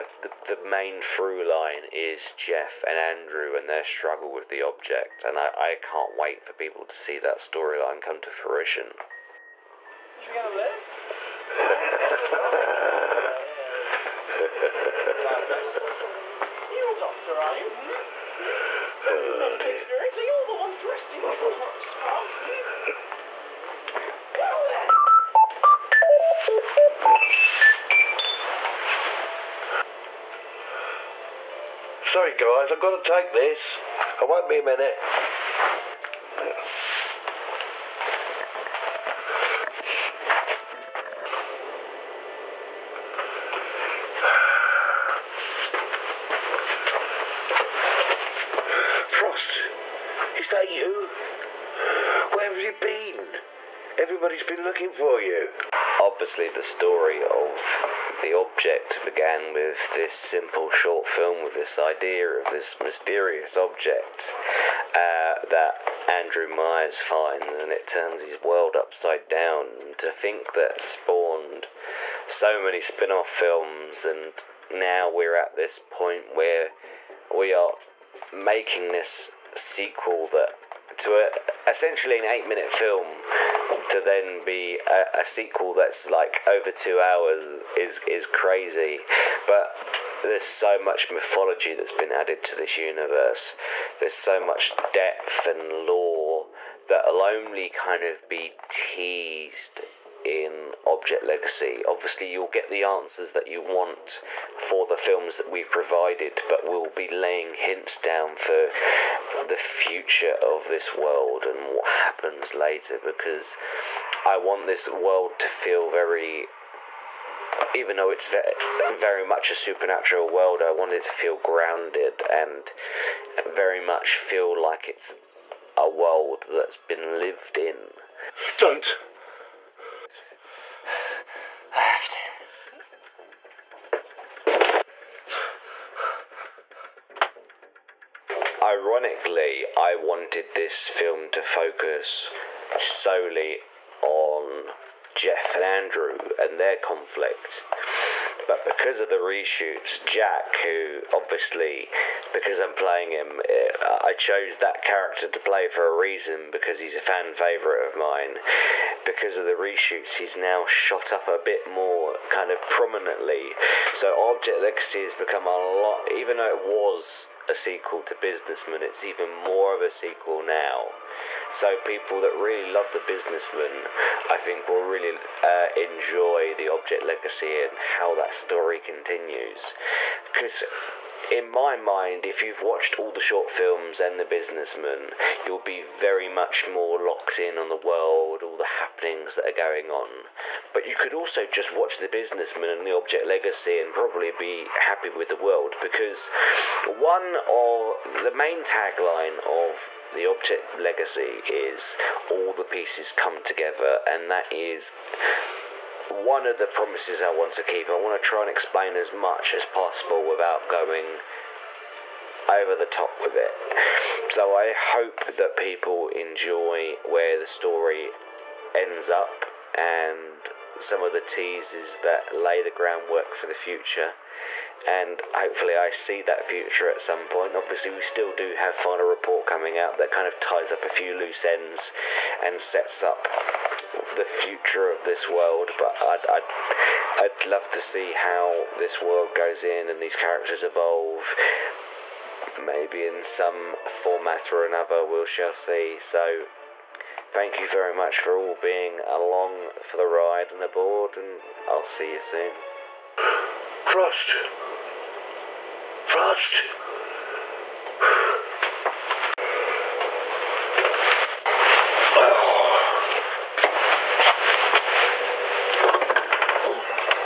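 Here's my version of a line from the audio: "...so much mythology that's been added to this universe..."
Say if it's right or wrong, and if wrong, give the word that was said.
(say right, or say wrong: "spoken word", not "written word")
right.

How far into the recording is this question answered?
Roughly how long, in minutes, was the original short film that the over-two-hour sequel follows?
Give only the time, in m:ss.
1:22.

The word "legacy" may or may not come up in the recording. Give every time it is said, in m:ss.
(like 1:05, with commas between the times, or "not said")
1:41, 2:44, 2:57, 3:13, 3:20.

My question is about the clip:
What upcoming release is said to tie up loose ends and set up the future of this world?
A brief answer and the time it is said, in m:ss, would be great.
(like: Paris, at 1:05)
Final Report, at 3:48.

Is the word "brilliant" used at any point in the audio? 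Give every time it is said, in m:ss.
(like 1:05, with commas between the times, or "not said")
not said.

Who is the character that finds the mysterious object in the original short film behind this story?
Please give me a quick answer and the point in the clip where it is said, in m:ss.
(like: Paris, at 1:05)
Andrew Myers, at 1:06.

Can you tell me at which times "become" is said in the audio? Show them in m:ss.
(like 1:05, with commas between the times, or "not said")
2:45.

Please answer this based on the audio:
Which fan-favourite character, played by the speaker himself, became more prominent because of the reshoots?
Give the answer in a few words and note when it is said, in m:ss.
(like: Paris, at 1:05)
Jack, at 2:30.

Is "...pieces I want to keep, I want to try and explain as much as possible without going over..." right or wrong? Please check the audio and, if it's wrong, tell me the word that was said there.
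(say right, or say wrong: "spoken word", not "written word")
wrong: "promises", not "pieces".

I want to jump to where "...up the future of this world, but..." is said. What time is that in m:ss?
3:53.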